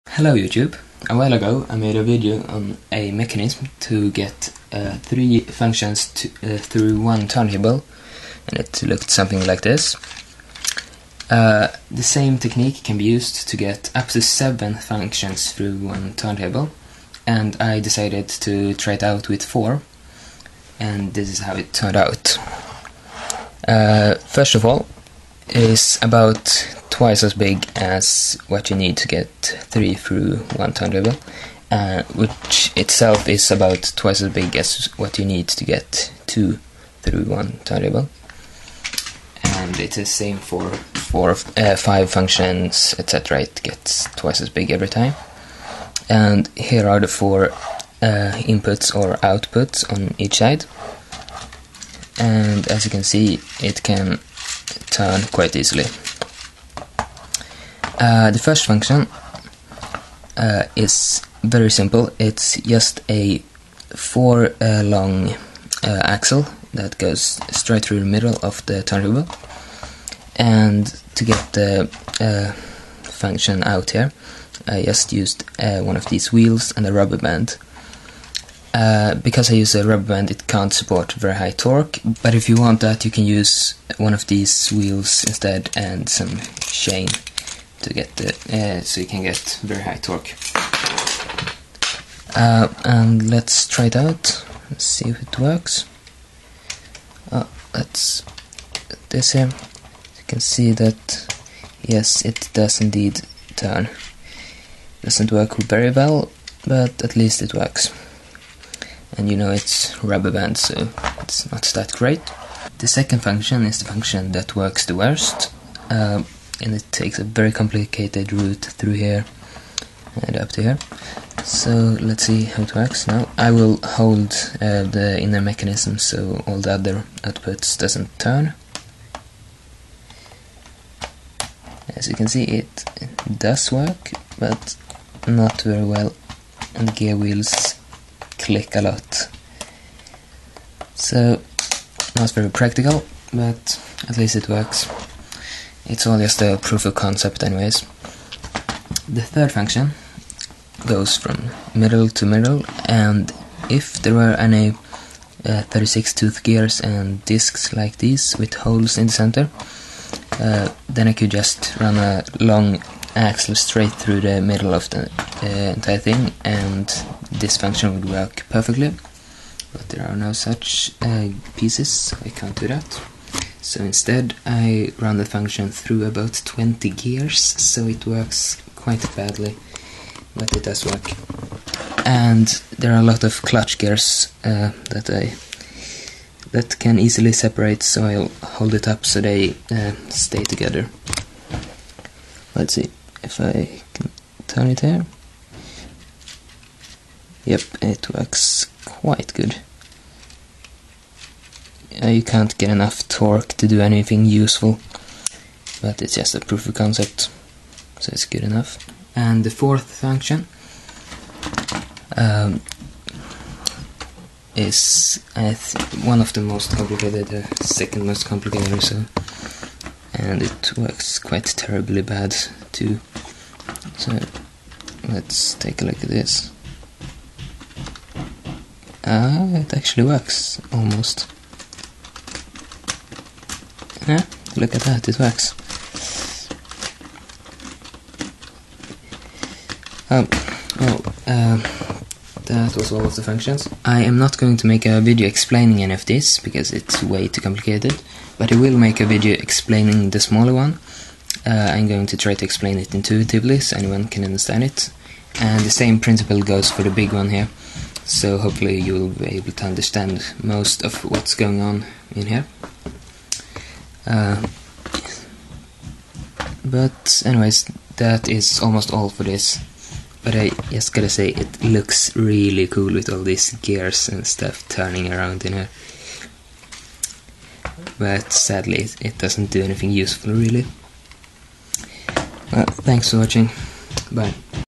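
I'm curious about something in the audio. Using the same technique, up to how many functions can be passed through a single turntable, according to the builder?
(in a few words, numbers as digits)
7.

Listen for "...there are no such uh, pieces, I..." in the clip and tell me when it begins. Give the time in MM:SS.
02:49.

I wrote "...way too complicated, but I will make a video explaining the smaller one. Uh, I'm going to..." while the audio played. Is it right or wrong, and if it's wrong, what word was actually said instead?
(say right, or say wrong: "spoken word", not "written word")
right.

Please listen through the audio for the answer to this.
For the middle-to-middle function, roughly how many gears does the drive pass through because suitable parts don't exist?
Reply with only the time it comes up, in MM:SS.
02:56.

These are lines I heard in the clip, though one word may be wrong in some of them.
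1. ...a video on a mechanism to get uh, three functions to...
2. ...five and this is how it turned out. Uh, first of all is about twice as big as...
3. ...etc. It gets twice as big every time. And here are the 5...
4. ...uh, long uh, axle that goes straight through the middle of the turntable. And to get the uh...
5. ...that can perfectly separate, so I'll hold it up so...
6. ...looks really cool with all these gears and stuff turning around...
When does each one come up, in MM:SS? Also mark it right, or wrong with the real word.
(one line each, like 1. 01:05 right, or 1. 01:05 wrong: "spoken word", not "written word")
1. 00:01 right
2. 00:19 wrong: "four", not "five"
3. 00:42 wrong: "4", not "5"
4. 01:04 right
5. 03:06 wrong: "easily", not "perfectly"
6. 04:31 right.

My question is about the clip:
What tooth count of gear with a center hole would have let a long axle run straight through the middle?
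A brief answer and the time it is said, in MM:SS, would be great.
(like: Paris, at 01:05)
36, at 02:35.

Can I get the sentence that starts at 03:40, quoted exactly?
And it works quite terribly bad too.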